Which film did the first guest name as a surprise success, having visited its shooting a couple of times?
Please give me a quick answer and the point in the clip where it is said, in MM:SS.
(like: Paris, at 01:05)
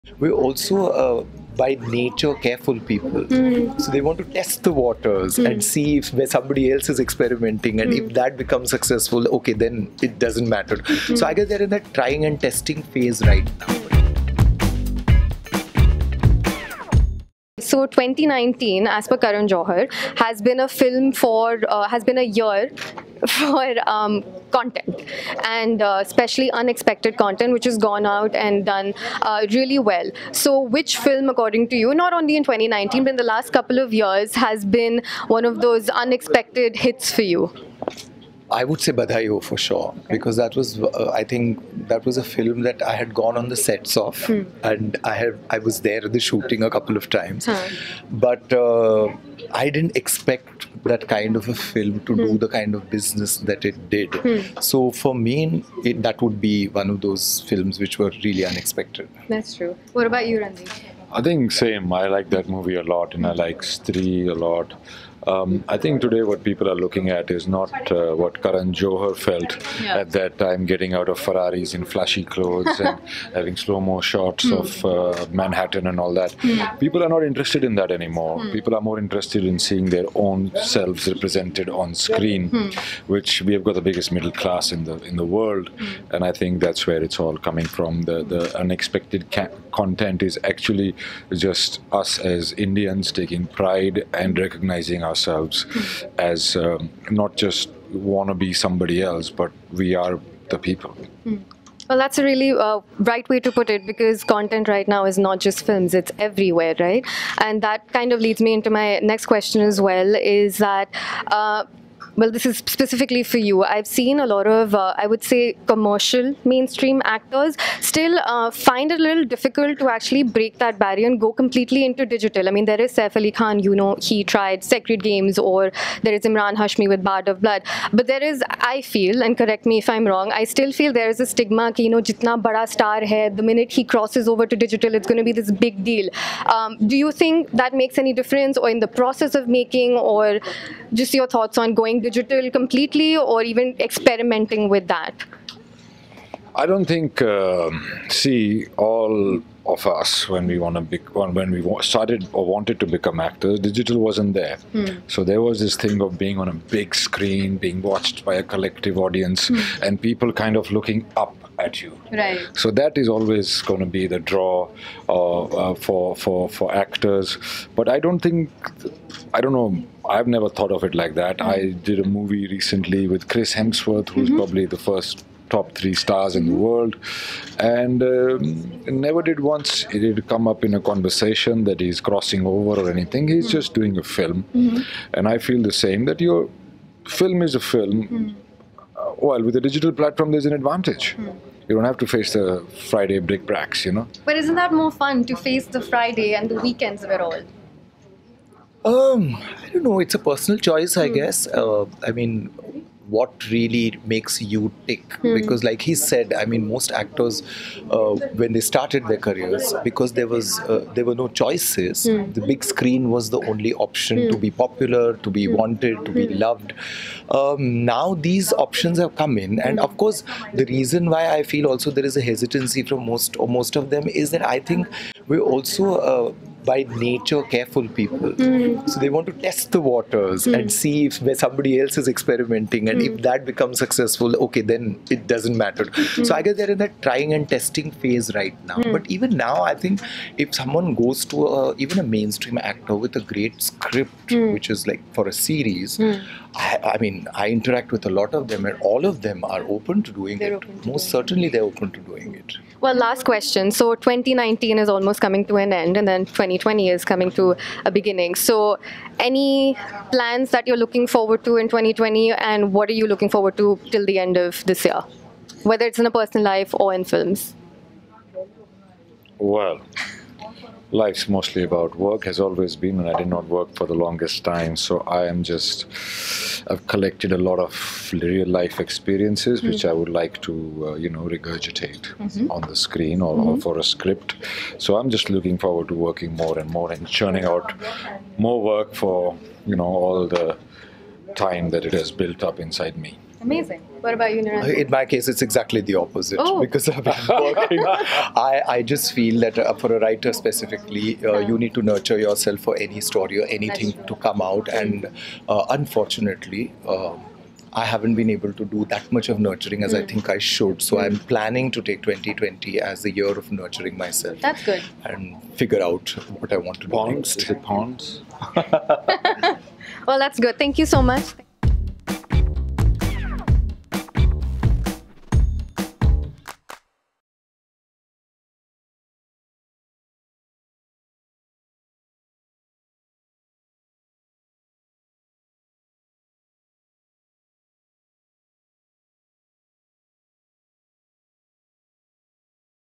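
Badhai Ho, at 00:38.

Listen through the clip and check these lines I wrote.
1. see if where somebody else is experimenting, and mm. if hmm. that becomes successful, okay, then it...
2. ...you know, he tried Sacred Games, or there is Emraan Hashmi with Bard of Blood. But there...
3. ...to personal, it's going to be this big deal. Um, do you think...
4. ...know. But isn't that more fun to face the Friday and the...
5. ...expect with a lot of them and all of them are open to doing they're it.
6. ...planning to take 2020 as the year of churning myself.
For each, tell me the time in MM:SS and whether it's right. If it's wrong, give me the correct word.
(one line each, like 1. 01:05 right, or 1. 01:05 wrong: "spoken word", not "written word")
1. 00:05 right
2. 02:03 right
3. 02:14 wrong: "digital", not "personal"
4. 03:13 right
5. 04:07 wrong: "interact", not "expect"
6. 05:11 wrong: "nurturing", not "churning".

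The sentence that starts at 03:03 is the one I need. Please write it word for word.
He's mm just doing a film.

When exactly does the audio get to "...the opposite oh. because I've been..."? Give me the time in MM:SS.
04:55.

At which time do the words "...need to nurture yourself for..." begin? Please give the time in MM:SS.
05:01.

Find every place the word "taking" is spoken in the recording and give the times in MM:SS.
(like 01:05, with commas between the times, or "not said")
01:33.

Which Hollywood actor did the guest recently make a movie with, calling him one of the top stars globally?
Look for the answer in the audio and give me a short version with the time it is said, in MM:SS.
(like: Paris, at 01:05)
Chris Hemsworth, at 02:53.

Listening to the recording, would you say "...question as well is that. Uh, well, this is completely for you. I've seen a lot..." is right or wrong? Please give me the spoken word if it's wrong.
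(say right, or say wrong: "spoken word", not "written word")
wrong: "specifically", not "completely".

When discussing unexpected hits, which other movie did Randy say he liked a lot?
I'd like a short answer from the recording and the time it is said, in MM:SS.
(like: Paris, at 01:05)
Stree, at 01:03.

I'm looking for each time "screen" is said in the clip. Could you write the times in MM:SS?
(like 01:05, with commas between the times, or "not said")
01:21, 02:36, 03:32, 04:42.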